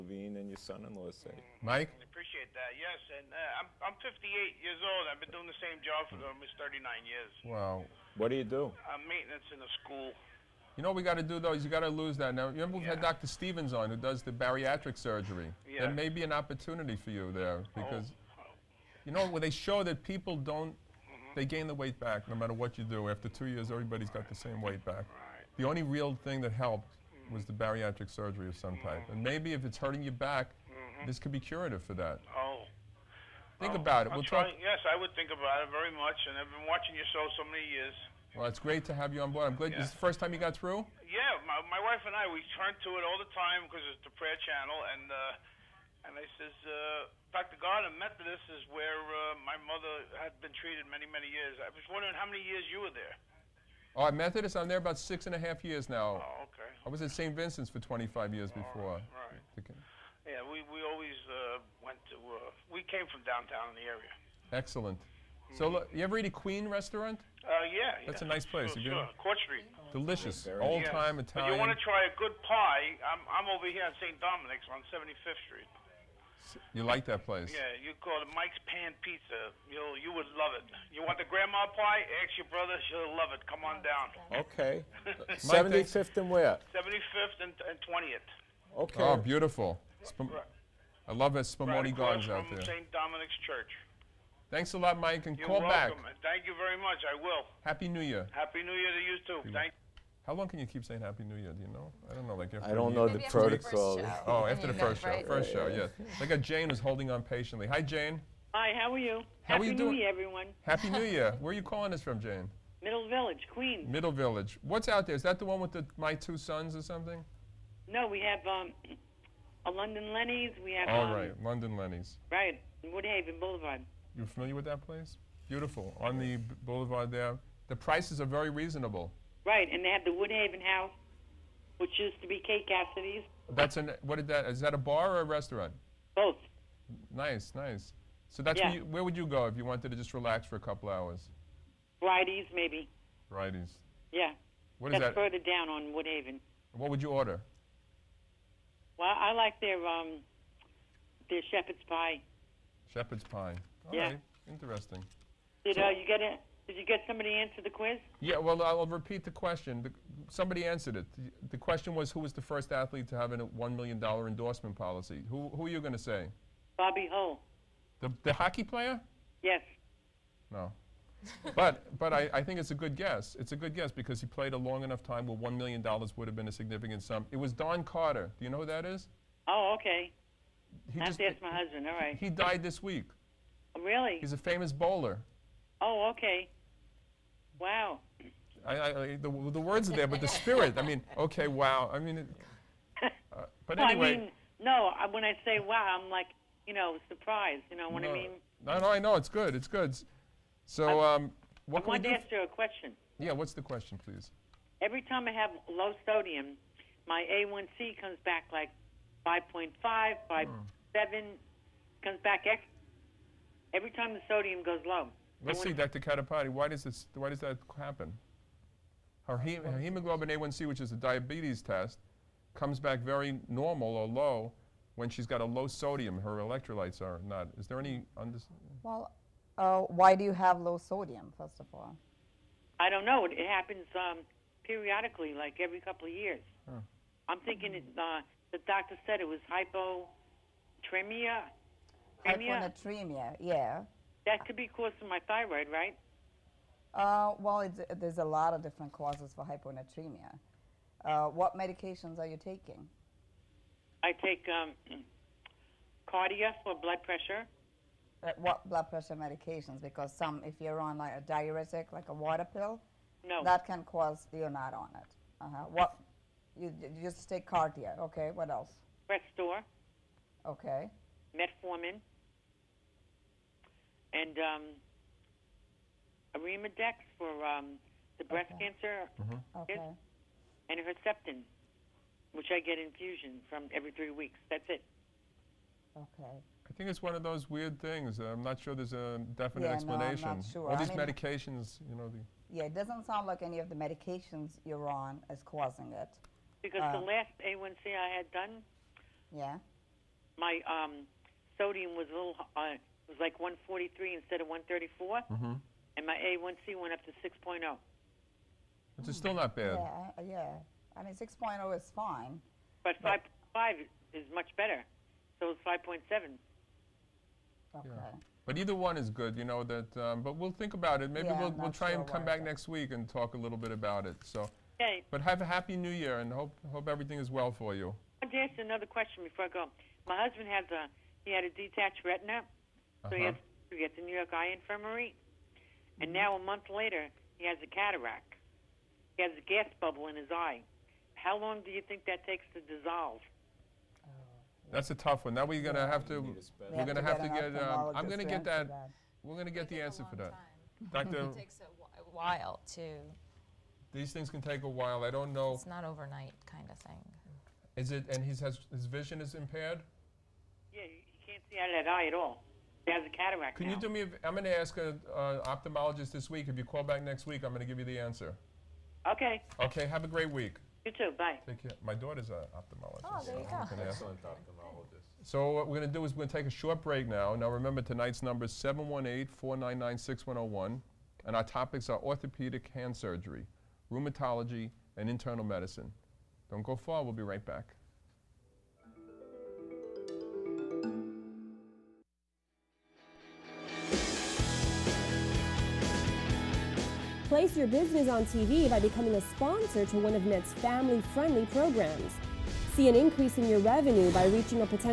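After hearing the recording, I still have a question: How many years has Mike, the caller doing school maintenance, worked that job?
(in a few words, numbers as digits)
39 years.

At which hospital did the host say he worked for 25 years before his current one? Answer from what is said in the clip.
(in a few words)
St. Vincent's.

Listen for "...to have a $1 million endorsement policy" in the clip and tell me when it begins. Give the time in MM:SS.
02:43.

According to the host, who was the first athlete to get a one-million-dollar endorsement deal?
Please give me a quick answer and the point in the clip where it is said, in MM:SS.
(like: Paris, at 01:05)
Don Carter, at 02:57.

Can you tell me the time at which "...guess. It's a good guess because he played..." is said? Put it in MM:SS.
02:52.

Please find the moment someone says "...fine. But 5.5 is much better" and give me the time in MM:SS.
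05:11.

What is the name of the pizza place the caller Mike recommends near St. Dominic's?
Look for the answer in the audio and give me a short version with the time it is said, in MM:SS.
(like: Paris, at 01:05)
Mike's Pan Pizza, at 01:18.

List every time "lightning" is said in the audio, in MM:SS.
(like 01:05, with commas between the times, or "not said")
not said.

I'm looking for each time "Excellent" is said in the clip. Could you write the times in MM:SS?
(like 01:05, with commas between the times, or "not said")
01:04, 06:13.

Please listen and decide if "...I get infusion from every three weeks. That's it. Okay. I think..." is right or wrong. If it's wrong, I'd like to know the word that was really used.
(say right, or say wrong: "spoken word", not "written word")
right.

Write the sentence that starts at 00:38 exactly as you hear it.
Well, it's great to have you on board.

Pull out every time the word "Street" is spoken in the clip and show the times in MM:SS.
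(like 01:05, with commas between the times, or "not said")
01:09, 01:15.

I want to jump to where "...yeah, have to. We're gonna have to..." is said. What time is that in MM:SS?
05:45.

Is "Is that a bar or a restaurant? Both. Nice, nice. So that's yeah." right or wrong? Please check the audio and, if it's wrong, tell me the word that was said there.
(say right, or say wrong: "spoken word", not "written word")
right.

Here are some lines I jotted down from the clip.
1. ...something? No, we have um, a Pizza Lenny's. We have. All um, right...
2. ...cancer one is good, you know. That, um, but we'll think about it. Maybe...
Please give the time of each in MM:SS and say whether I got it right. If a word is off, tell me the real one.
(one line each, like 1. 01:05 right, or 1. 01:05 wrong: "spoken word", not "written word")
1. 01:56 wrong: "London", not "Pizza"
2. 05:18 wrong: "either", not "cancer".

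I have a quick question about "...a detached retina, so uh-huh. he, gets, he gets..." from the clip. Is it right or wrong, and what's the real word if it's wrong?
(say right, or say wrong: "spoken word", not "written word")
right.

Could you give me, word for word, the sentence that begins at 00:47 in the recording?
Gardner, Methodist is where uh, my mother had been treated many many years.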